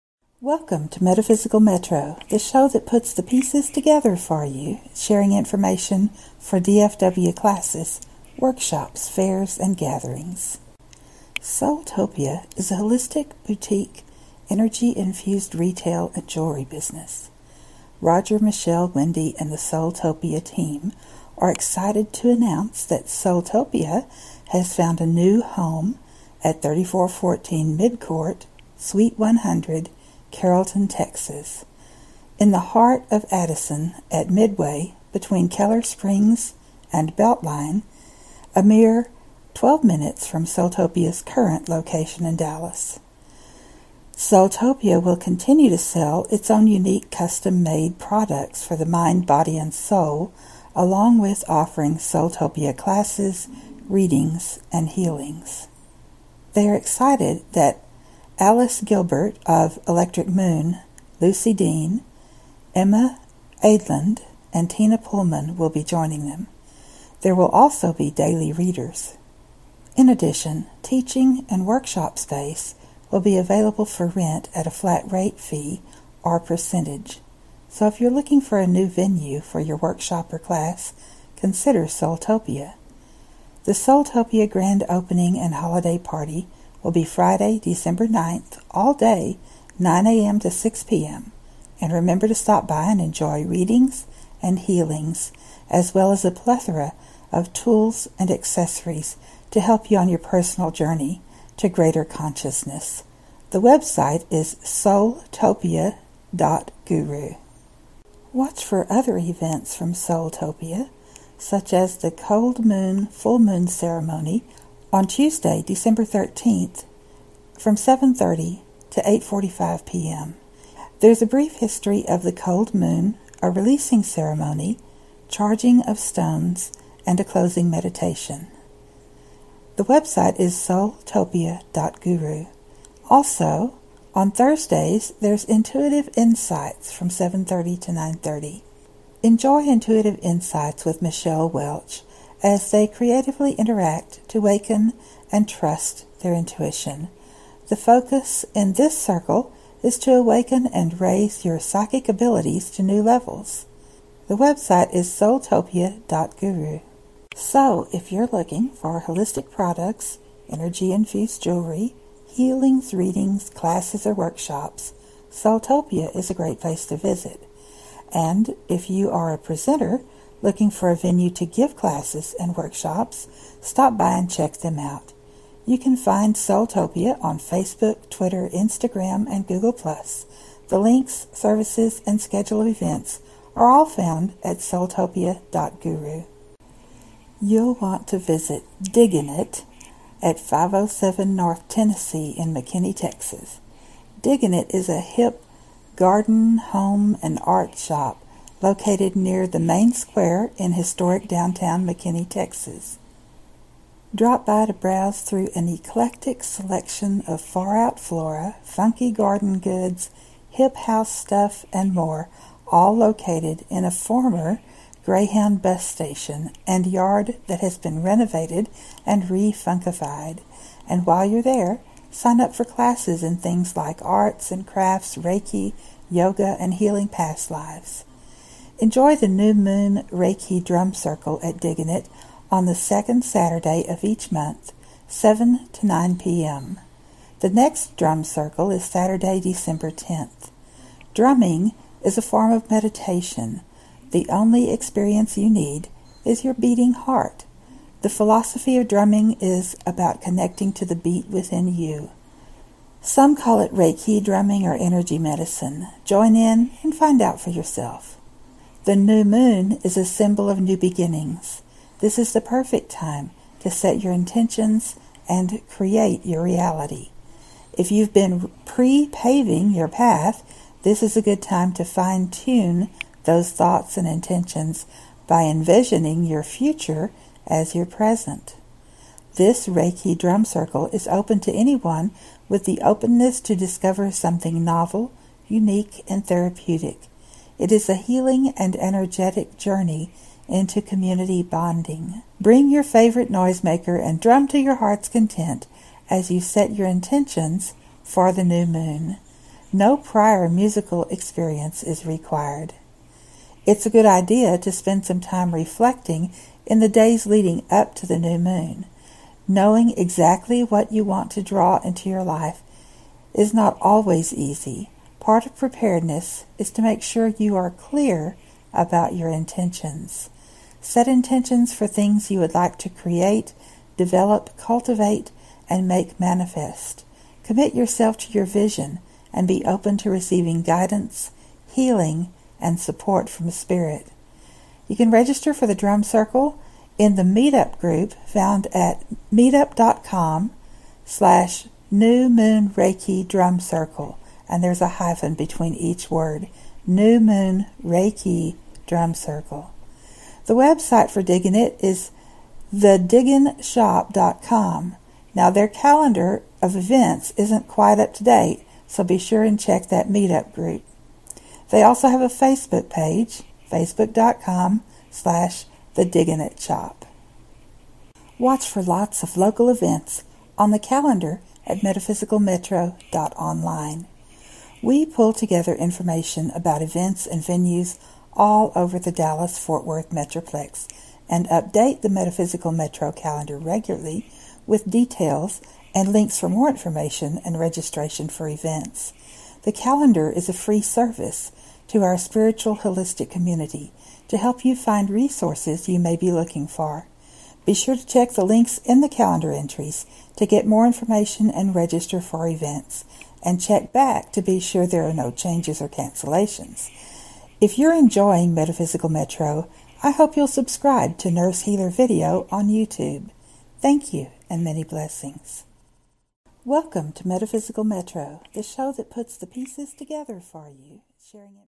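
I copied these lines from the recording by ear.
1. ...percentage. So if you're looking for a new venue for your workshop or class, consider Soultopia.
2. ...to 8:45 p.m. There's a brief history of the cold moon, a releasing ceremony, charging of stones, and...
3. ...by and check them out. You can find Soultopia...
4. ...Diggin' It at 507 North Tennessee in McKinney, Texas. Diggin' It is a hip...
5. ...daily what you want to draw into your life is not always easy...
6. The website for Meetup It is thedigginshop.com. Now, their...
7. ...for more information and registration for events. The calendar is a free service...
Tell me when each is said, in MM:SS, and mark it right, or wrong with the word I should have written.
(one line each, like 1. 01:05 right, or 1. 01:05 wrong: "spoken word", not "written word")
1. 01:16 right
2. 01:58 right
3. 02:53 right
4. 03:08 right
5. 05:09 wrong: "exactly", not "daily"
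6. 05:50 wrong: "Digging", not "Meetup"
7. 06:26 right.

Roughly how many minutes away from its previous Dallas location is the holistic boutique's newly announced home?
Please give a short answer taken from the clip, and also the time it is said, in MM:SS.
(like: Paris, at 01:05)
12, at 00:39.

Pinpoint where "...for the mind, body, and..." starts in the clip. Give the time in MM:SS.
00:48.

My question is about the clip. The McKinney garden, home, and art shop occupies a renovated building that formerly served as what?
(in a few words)
Greyhound bus station.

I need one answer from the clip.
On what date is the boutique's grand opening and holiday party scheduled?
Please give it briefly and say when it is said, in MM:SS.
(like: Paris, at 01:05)
December 9th, at 01:27.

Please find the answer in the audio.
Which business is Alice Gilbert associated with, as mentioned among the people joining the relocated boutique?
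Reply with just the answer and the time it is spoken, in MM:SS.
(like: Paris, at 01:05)
Electric Moon, at 00:59.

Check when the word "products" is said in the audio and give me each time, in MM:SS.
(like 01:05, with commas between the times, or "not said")
00:47, 02:39.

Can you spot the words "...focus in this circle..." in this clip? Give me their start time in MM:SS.
02:27.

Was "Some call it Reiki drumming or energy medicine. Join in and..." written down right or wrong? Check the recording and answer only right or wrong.
right.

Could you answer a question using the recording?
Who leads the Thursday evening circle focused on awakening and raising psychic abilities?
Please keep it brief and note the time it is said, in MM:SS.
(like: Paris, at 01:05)
Michelle Welch, at 02:21.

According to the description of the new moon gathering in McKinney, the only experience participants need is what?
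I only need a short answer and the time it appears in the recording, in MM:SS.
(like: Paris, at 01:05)
your beating heart, at 04:06.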